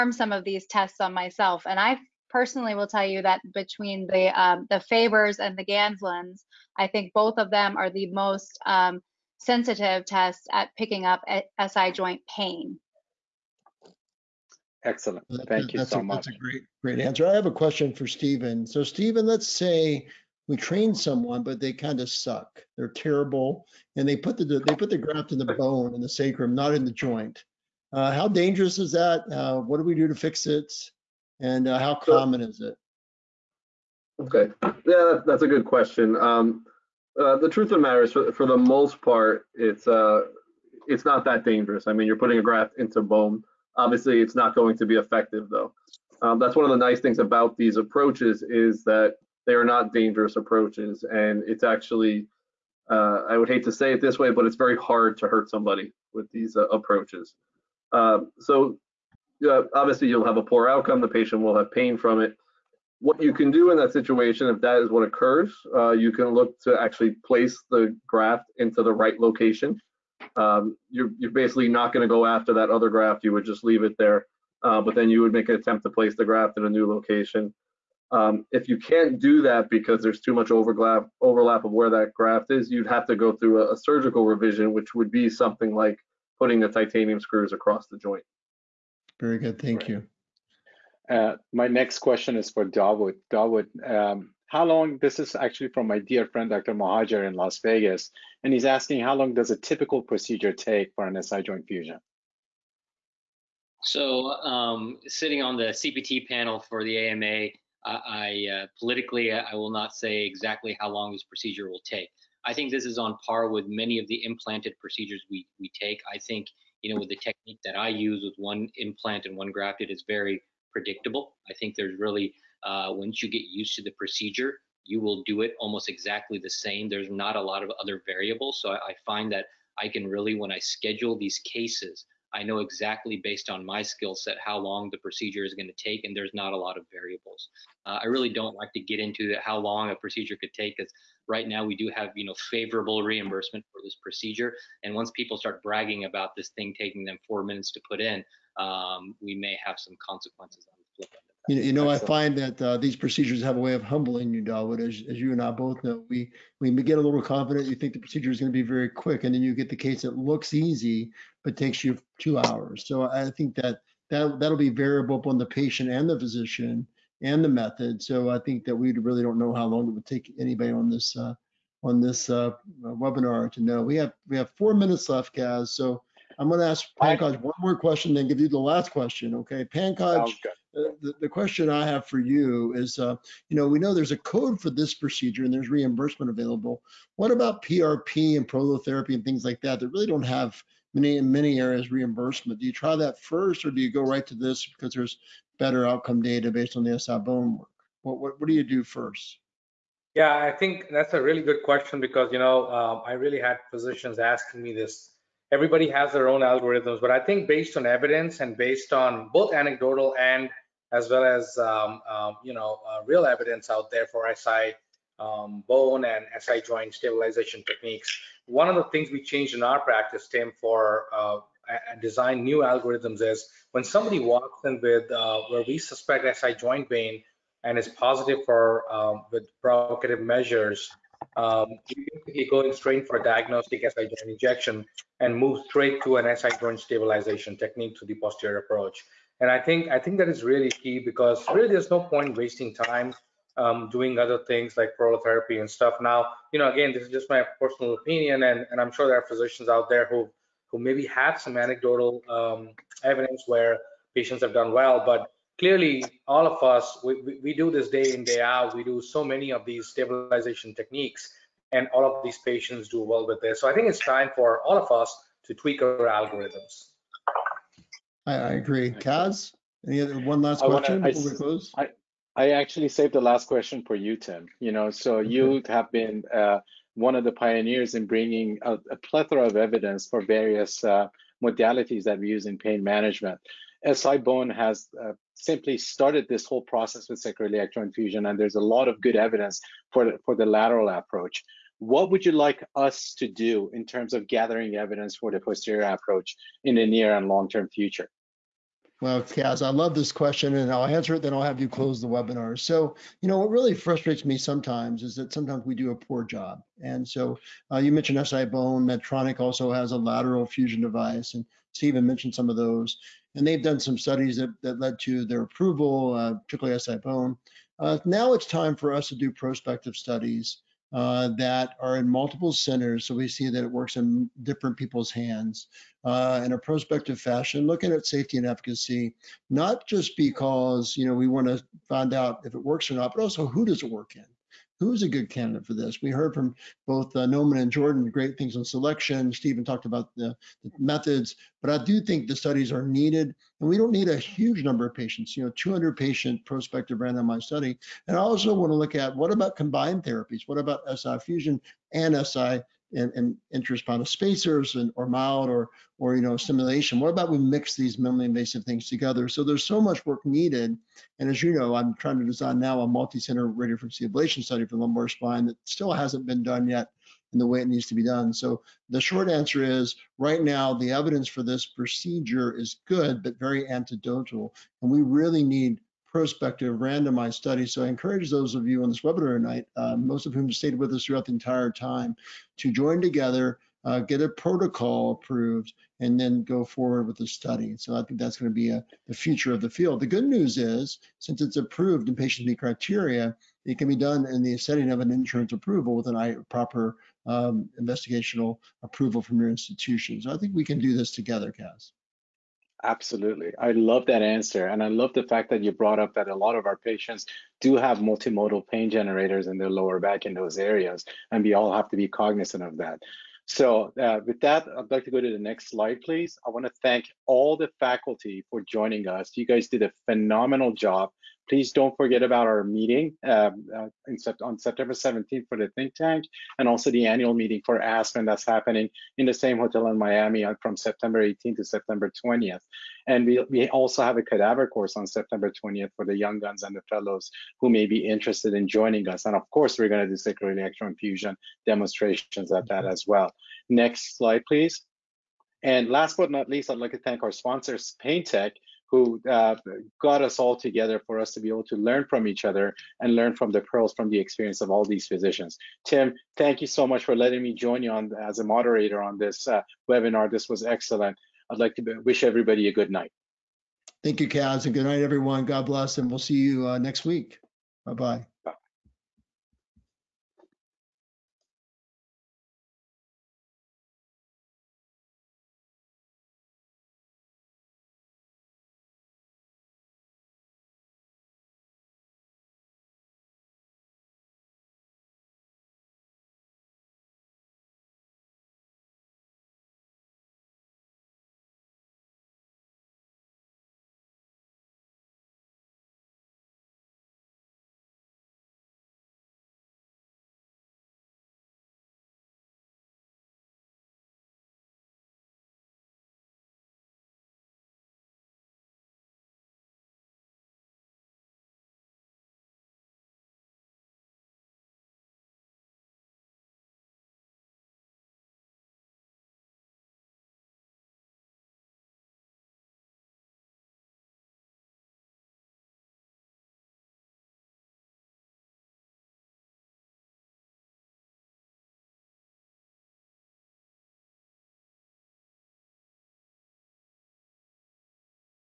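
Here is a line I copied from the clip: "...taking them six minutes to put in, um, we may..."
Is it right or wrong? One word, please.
wrong.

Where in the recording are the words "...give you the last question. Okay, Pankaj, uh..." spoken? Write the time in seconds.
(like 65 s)
178 s.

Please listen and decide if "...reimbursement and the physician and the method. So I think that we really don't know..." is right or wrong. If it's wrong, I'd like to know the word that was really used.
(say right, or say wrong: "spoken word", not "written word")
wrong: "patient", not "reimbursement".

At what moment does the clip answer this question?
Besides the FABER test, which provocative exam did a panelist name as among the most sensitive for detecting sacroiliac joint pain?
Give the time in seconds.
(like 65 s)
5 s.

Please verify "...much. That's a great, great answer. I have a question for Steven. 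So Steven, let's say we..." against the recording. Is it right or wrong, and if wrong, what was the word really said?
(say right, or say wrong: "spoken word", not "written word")
right.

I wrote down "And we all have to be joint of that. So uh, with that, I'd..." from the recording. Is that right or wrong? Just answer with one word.
wrong.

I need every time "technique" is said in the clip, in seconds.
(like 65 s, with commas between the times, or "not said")
117 s, 217 s, 237 s, 260 s.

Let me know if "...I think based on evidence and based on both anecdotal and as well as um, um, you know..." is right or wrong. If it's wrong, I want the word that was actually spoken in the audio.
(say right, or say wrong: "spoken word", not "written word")
right.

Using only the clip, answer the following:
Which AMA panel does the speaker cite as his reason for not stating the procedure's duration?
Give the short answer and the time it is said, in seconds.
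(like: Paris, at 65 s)
CPT panel, at 105 s.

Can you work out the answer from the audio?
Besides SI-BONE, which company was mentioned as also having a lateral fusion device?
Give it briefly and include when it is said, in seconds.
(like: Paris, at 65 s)
Medtronic, at 308 s.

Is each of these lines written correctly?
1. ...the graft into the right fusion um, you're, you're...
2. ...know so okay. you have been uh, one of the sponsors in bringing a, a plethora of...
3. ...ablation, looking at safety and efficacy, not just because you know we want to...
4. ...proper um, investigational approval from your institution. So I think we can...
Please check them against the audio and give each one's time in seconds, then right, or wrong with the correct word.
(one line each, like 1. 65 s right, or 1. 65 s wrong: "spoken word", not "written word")
1. 67 s wrong: "location", not "fusion"
2. 274 s wrong: "pioneers", not "sponsors"
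3. 327 s wrong: "fashion", not "ablation"
4. 396 s right.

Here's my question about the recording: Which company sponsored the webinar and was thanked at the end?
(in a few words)
PainTEQ.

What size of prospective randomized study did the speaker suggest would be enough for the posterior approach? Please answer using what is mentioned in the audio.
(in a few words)
200 patients.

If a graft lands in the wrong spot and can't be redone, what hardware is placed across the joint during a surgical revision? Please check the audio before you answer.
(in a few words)
titanium screws.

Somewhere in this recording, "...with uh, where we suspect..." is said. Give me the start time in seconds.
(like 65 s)
224 s.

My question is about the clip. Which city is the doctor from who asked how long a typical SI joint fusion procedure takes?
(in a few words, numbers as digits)
Las Vegas.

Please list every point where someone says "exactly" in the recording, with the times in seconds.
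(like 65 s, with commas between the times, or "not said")
110 s, 125 s, 132 s.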